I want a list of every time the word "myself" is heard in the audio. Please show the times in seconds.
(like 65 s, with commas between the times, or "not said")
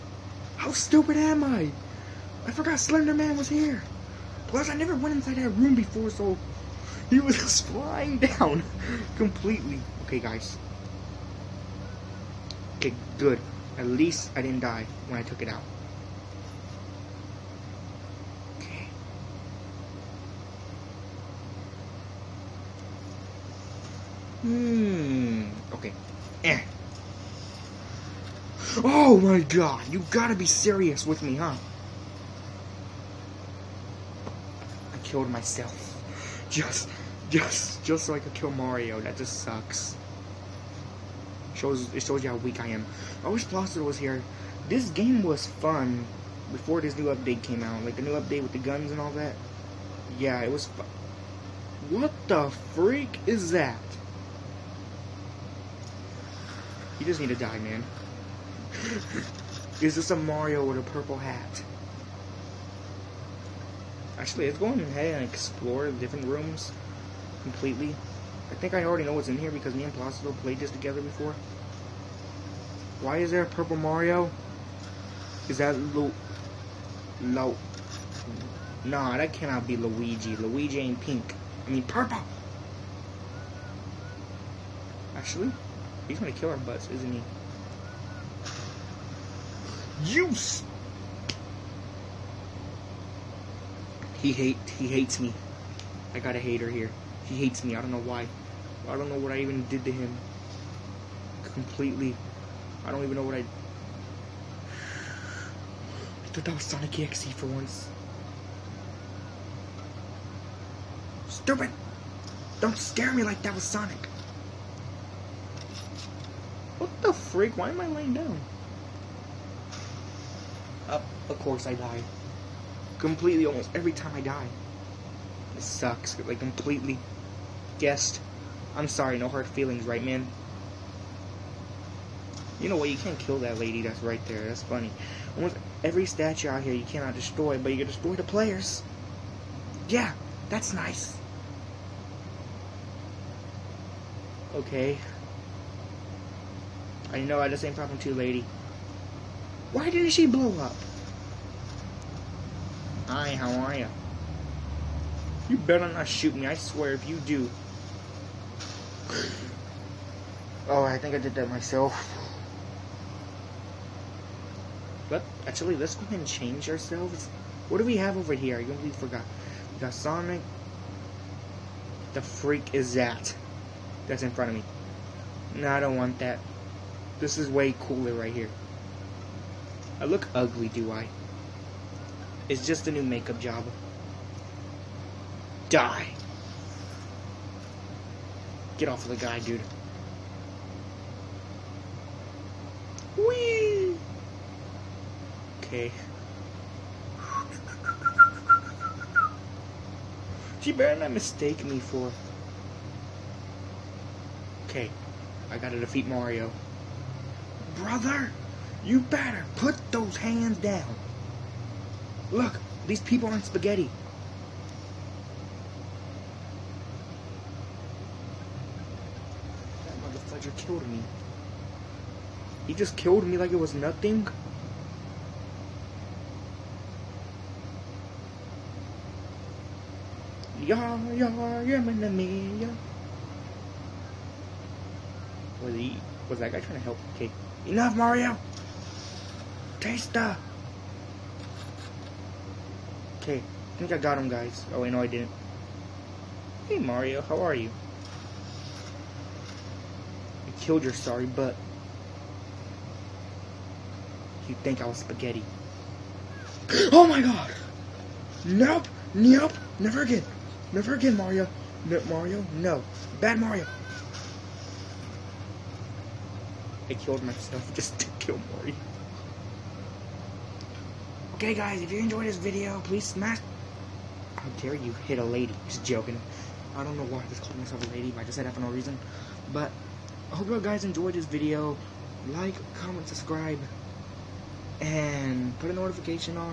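35 s, 161 s, 267 s, 277 s.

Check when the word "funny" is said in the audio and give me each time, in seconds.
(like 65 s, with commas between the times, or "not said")
134 s.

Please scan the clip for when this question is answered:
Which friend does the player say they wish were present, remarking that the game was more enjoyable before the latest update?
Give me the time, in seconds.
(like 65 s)
43 s.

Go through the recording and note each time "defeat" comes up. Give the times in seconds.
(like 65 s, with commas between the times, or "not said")
205 s.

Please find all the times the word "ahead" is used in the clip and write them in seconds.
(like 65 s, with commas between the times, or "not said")
64 s, 166 s.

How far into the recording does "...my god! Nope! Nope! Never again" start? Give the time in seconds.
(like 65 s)
257 s.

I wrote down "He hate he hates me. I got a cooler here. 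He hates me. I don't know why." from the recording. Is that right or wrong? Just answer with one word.
wrong.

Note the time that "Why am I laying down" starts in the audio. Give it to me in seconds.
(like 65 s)
117 s.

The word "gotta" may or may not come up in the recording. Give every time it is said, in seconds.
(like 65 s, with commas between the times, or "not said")
30 s, 205 s.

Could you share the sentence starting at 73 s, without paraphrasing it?
Why is there a purple Mario?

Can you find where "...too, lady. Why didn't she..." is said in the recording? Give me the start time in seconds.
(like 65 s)
147 s.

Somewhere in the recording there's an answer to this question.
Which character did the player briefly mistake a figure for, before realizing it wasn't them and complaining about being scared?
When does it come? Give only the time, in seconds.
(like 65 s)
106 s.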